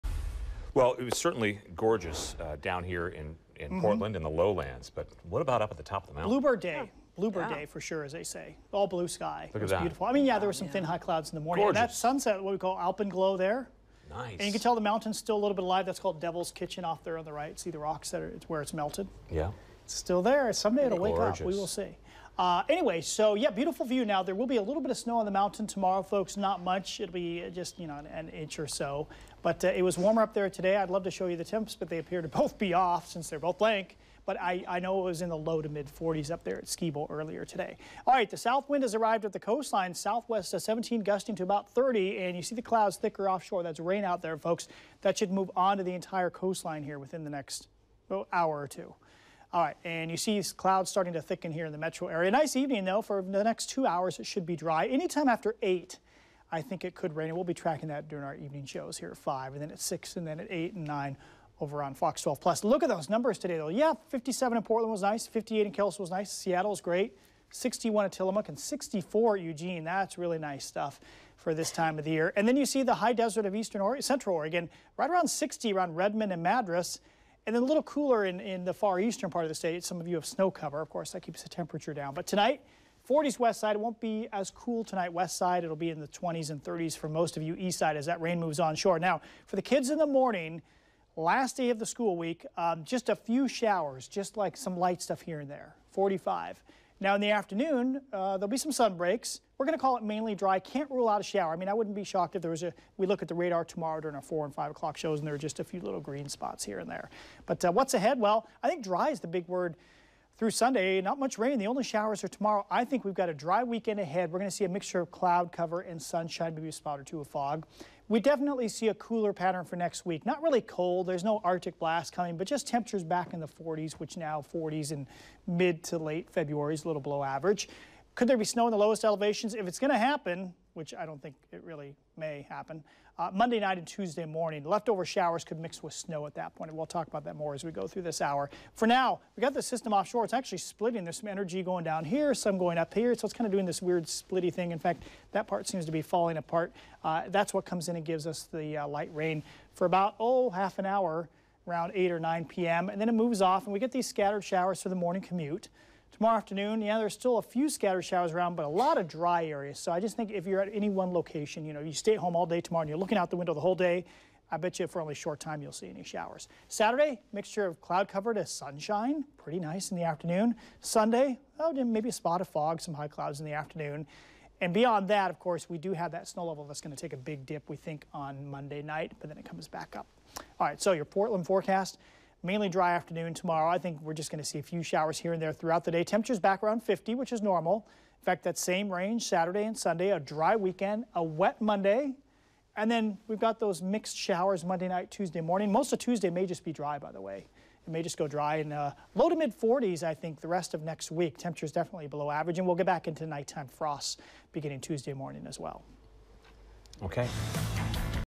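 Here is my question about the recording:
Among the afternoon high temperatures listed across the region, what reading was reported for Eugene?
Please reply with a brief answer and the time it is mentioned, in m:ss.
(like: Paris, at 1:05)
64, at 1:08.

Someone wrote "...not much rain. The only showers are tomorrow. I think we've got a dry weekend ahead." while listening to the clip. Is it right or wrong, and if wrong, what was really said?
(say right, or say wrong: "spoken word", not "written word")
right.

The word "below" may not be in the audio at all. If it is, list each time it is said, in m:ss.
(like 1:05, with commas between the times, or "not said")
2:07, 3:22.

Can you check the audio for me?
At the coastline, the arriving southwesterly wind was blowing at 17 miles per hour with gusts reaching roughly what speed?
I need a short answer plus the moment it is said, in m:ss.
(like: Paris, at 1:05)
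30, at 0:41.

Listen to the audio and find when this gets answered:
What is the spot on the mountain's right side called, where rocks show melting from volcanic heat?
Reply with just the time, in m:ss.
0:16.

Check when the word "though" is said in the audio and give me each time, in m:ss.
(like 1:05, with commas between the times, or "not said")
0:52, 1:03.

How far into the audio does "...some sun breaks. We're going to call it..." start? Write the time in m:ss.
1:38.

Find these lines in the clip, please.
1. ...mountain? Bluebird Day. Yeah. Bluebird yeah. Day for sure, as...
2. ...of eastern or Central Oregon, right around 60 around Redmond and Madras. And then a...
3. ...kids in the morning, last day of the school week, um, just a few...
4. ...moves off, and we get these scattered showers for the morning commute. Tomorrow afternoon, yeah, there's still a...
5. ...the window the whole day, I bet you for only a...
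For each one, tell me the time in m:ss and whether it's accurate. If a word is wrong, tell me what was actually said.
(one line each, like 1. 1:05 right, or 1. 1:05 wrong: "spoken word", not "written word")
1. 0:06 right
2. 1:13 right
3. 1:29 right
4. 2:33 right
5. 2:43 right.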